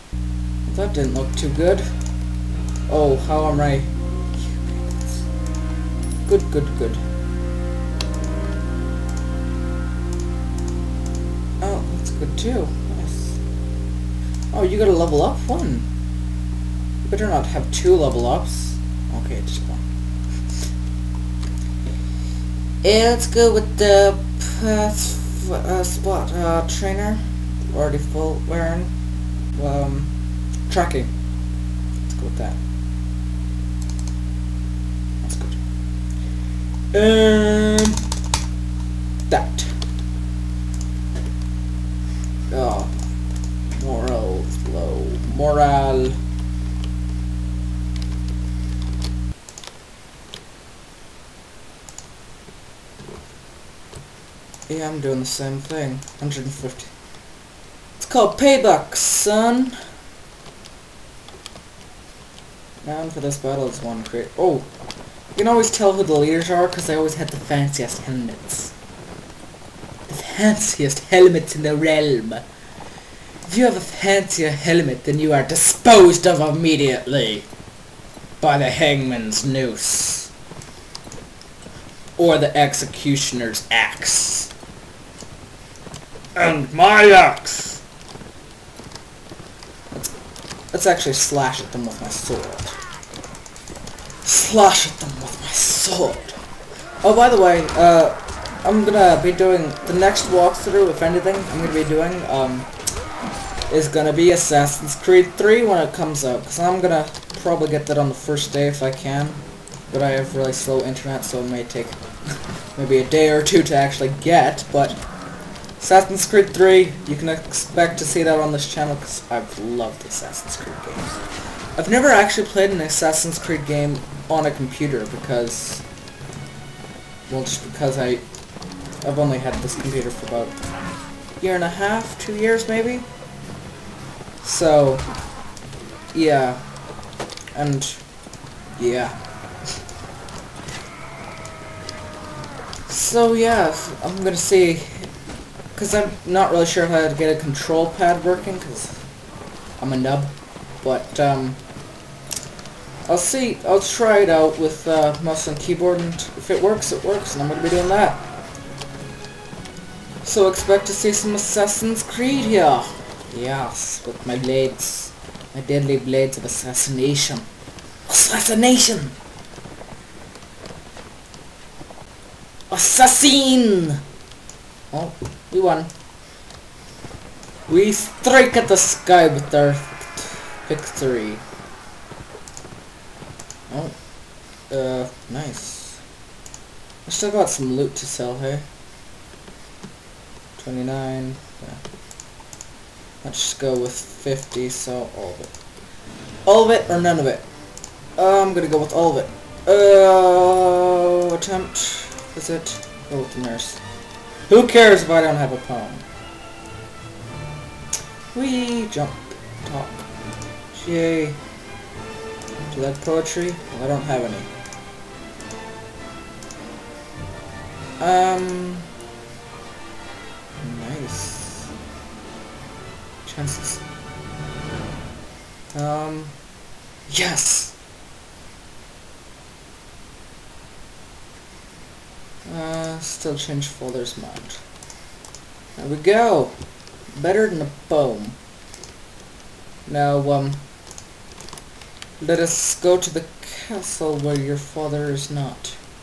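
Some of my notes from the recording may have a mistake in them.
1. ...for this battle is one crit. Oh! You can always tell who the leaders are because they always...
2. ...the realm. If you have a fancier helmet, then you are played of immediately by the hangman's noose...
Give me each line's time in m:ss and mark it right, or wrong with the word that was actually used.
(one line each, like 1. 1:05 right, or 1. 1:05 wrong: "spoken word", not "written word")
1. 1:03 right
2. 1:11 wrong: "disposed", not "played".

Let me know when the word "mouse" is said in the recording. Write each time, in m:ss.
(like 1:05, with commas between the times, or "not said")
2:35.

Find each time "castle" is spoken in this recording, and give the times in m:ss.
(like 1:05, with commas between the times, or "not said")
4:03.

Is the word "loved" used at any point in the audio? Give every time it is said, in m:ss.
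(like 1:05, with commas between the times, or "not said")
1:59.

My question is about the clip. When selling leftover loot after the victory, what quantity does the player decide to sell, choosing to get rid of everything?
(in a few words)
50.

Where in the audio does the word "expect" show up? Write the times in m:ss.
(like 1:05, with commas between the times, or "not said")
1:57, 2:40.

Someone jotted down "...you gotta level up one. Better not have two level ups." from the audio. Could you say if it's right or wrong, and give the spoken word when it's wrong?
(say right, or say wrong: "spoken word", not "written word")
right.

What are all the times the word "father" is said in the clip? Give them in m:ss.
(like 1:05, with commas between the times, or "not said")
4:04.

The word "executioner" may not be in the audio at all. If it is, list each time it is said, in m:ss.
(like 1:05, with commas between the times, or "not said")
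1:22.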